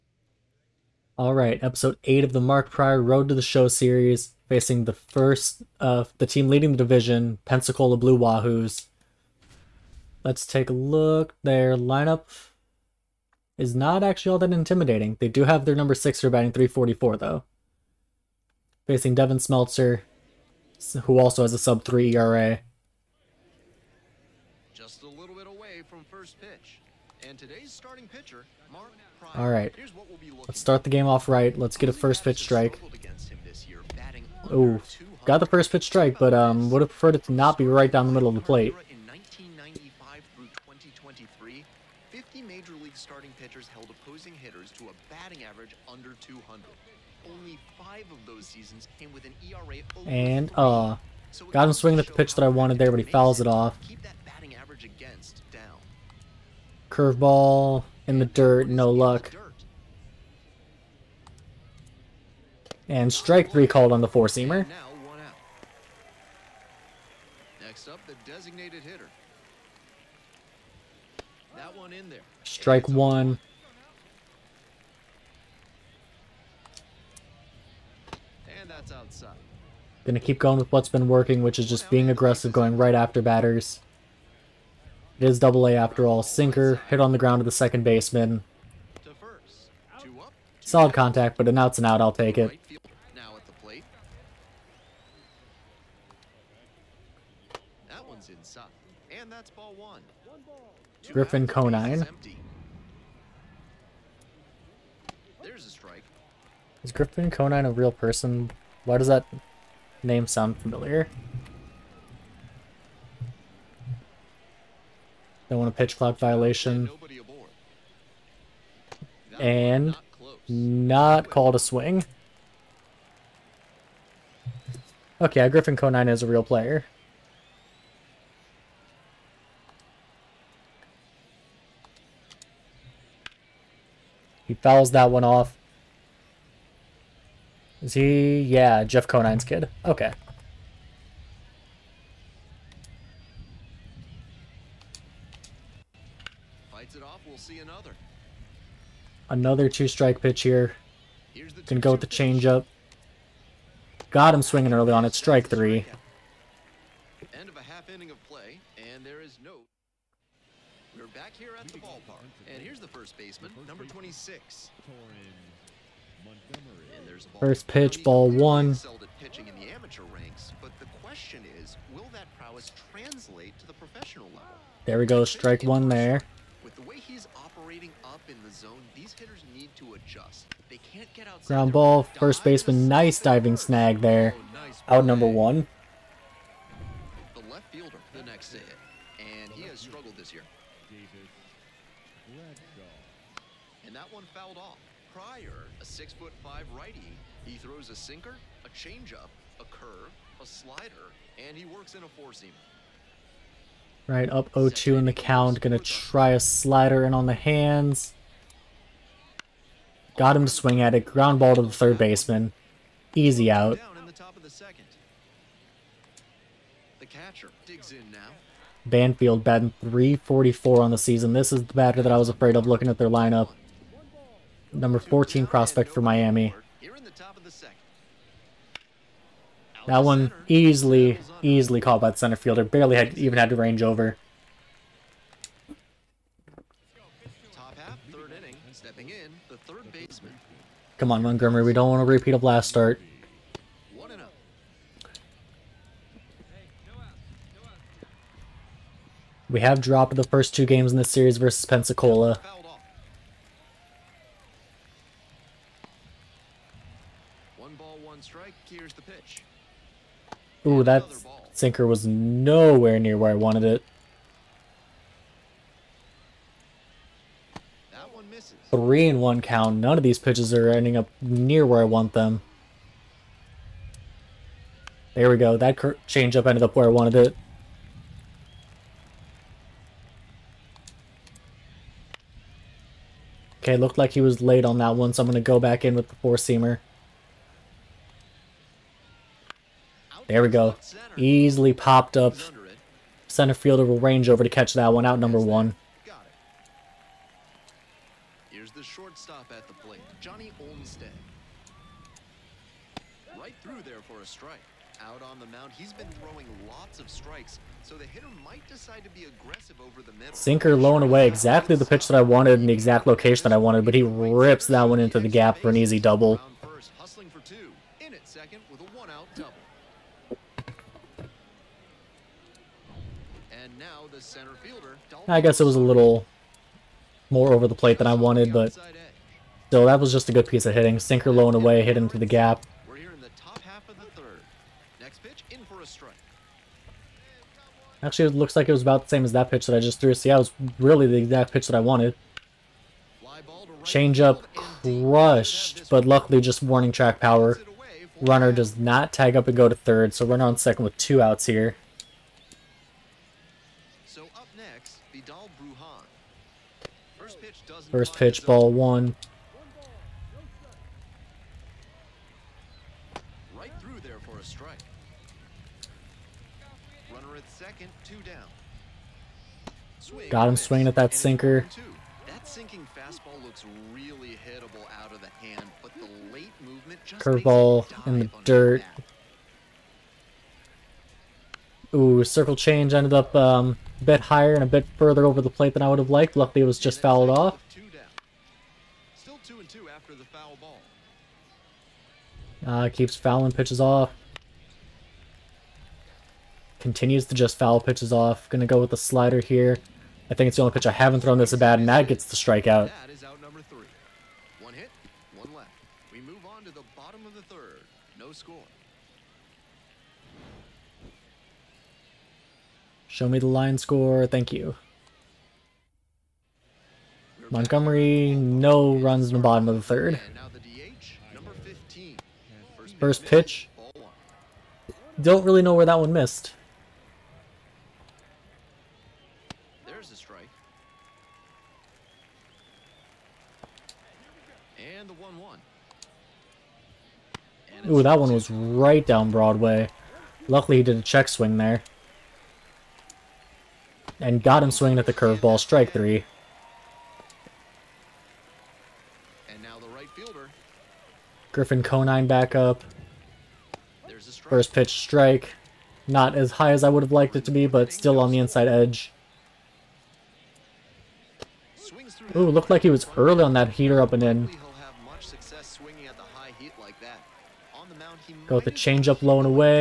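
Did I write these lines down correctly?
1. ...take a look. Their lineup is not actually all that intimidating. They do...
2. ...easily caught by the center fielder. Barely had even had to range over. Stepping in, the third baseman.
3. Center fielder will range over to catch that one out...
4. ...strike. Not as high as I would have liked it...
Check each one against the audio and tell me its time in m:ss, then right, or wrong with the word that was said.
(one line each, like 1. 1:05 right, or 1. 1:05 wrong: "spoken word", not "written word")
1. 0:10 right
2. 3:51 right
3. 4:53 right
4. 7:34 right.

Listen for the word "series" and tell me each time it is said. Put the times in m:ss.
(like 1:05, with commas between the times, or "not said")
0:03, 4:11.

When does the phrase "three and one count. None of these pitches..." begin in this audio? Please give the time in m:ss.
4:28.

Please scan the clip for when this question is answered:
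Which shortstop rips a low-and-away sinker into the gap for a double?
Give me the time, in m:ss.
5:00.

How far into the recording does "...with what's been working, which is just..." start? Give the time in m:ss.
1:20.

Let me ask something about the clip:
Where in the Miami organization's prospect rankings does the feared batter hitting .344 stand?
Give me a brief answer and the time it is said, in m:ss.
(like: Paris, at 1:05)
Number 14, at 3:44.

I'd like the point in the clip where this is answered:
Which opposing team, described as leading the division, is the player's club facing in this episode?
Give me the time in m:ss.
0:07.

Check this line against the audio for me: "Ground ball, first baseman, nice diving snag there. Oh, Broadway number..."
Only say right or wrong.
wrong.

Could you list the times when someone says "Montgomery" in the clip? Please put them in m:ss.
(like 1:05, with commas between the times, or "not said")
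4:01, 6:57.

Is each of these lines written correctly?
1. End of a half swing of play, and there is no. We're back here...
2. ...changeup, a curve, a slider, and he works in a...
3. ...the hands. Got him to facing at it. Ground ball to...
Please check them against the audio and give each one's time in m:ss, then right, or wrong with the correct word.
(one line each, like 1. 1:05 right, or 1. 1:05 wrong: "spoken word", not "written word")
1. 2:37 wrong: "inning", not "swing"
2. 3:18 right
3. 3:27 wrong: "swing", not "facing".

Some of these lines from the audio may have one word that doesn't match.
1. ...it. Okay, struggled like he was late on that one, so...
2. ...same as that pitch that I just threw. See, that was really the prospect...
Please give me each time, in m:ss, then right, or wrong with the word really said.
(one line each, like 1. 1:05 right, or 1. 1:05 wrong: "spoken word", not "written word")
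1. 4:37 wrong: "looked", not "struggled"
2. 5:39 wrong: "exact", not "prospect".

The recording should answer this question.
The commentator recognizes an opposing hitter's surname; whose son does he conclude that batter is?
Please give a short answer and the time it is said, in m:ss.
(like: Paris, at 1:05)
Jeff Conine, at 2:18.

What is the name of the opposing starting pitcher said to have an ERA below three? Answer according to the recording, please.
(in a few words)
Devin Smeltzer.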